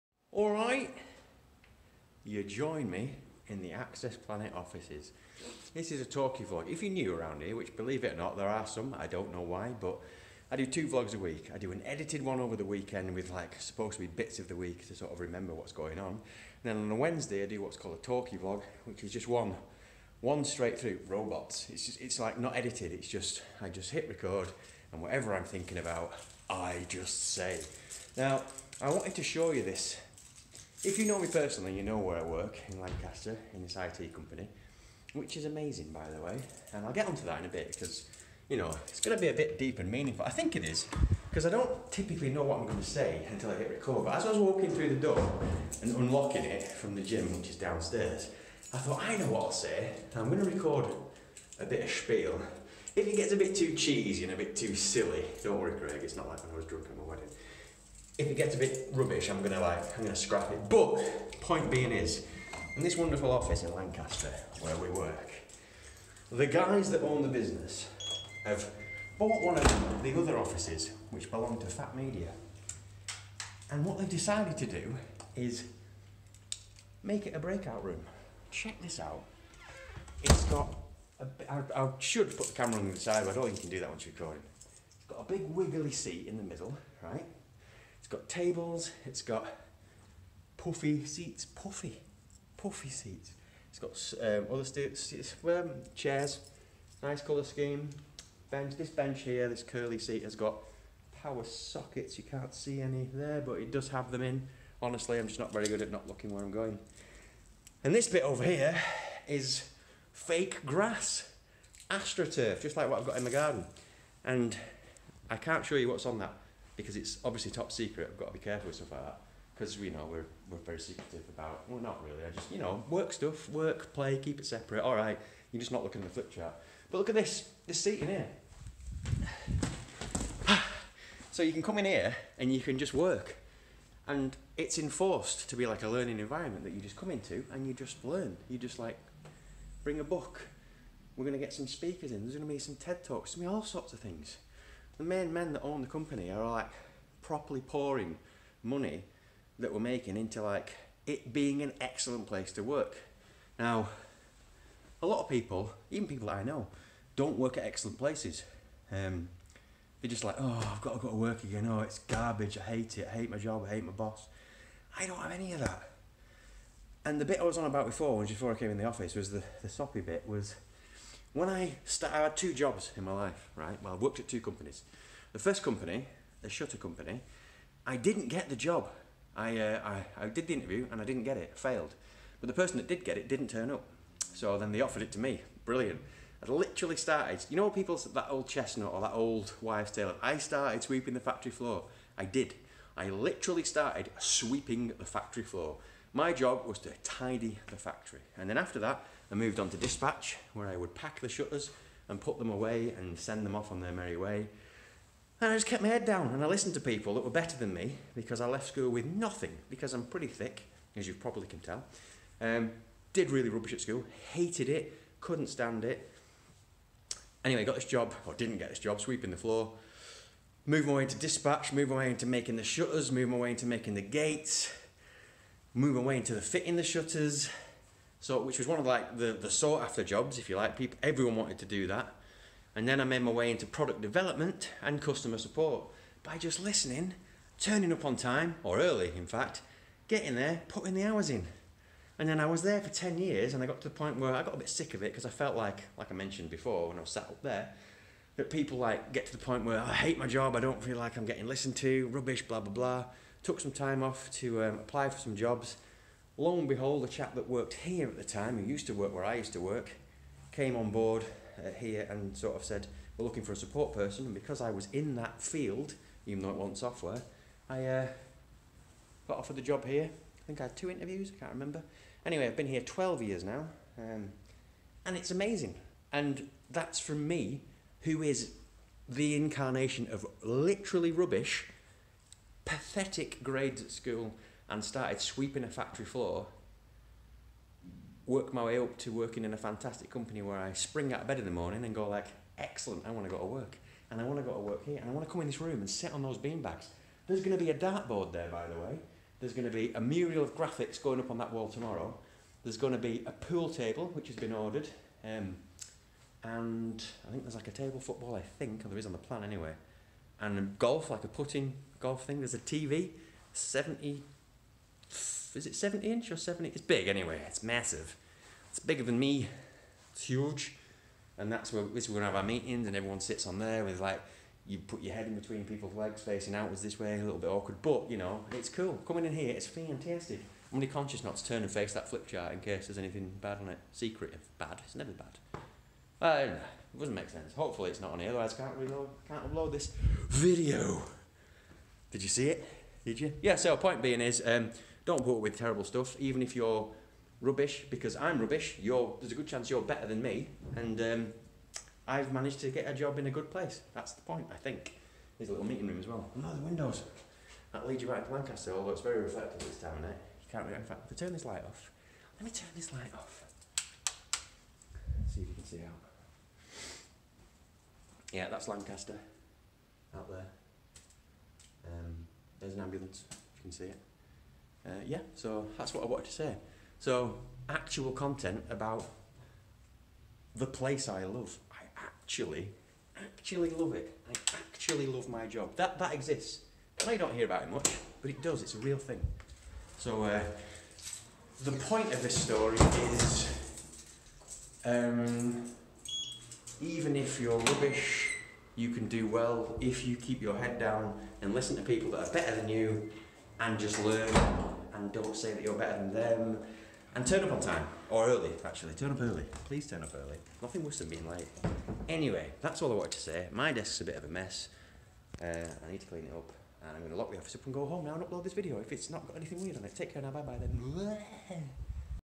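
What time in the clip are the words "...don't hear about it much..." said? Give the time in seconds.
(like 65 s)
387 s.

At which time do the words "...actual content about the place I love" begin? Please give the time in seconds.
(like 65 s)
377 s.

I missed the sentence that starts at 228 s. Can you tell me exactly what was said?
So, which was one of like the, the sought after jobs, if you like.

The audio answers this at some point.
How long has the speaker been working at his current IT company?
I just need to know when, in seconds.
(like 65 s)
272 s.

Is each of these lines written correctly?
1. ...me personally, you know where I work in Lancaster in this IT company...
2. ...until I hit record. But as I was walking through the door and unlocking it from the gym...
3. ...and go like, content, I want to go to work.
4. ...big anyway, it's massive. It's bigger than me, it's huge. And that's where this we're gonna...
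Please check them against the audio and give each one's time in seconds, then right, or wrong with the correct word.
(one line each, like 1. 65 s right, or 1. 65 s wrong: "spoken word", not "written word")
1. 31 s right
2. 43 s right
3. 291 s wrong: "excellent", not "content"
4. 316 s right.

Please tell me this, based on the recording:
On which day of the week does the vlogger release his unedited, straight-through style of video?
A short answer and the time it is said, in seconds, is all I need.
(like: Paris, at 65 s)
Wednesday, at 16 s.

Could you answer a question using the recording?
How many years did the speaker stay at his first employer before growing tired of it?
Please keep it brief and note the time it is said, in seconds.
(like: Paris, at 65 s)
10, at 242 s.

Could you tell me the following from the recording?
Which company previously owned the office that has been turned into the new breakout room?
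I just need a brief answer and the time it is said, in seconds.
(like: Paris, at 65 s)
Fat Media, at 71 s.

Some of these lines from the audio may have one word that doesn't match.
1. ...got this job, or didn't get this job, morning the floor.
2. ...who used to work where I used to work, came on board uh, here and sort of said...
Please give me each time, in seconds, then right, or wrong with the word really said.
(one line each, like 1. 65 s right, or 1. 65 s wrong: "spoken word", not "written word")
1. 217 s wrong: "sweeping", not "morning"
2. 258 s right.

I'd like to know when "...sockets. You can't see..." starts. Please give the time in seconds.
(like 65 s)
101 s.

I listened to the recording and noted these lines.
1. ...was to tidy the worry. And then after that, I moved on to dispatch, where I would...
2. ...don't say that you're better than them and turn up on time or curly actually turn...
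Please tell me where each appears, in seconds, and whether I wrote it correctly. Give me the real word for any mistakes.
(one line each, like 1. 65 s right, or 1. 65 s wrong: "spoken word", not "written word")
1. 196 s wrong: "factory", not "worry"
2. 405 s wrong: "early", not "curly".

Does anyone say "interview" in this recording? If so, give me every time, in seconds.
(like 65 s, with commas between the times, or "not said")
180 s, 270 s.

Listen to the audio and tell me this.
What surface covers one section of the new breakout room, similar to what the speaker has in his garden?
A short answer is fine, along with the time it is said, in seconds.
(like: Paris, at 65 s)
Astroturf, at 111 s.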